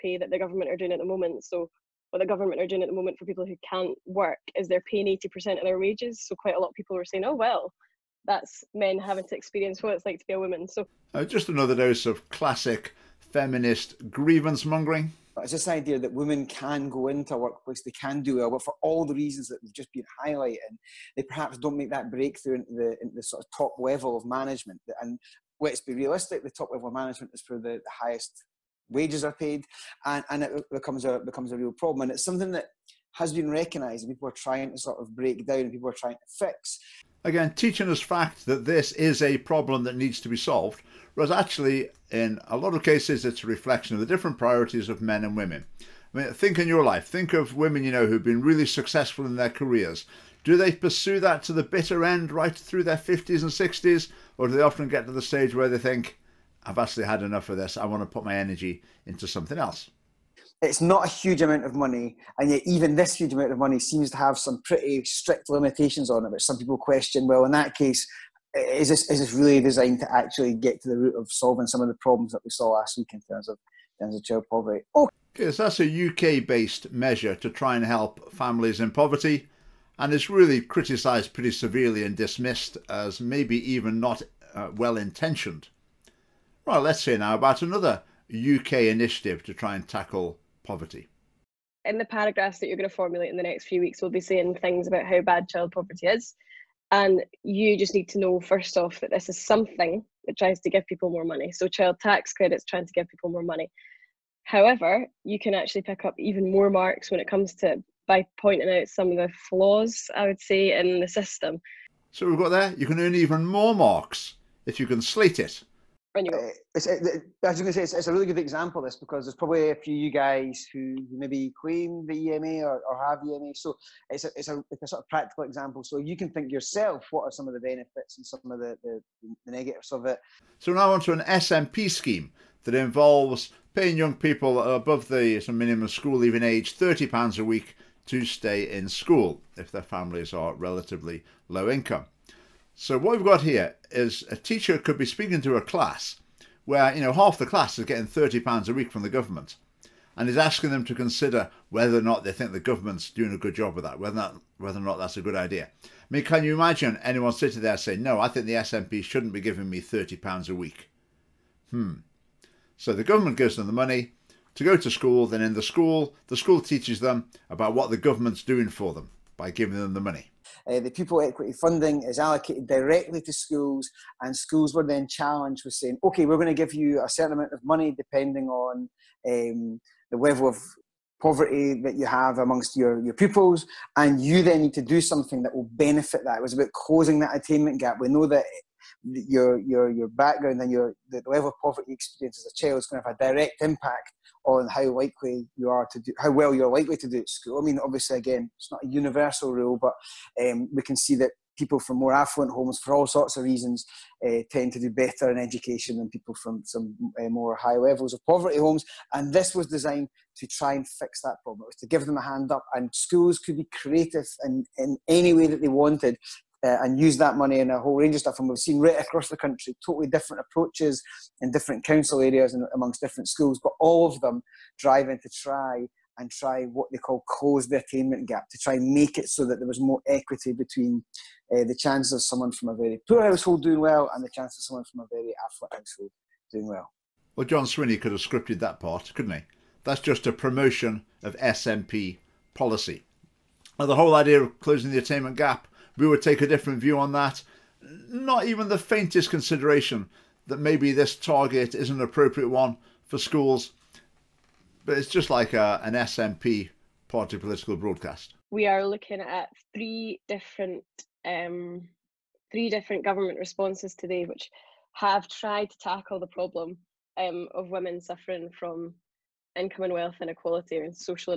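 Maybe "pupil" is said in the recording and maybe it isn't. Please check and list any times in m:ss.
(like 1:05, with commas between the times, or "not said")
2:50, 3:03.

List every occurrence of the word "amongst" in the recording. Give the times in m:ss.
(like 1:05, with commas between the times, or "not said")
3:02, 3:42.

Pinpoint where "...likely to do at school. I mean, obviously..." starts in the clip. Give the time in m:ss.
3:16.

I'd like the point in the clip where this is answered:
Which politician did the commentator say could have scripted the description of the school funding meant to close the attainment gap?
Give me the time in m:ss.
3:57.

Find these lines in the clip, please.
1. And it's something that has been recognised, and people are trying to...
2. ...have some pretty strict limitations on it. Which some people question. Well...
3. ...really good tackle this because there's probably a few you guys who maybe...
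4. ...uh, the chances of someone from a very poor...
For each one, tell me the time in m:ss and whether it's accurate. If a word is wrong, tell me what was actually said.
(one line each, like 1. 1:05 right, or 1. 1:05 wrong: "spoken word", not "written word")
1. 0:32 right
2. 1:04 right
3. 1:58 wrong: "example", not "tackle"
4. 3:51 right.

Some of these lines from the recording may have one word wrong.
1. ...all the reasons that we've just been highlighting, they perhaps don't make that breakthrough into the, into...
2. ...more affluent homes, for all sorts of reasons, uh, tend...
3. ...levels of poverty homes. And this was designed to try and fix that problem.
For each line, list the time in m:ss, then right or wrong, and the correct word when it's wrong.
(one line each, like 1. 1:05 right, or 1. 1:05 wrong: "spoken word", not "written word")
1. 0:18 right
2. 3:21 right
3. 3:27 right.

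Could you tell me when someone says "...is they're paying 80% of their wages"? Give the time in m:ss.
0:04.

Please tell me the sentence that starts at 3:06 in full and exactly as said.
It was about closing that attainment gap.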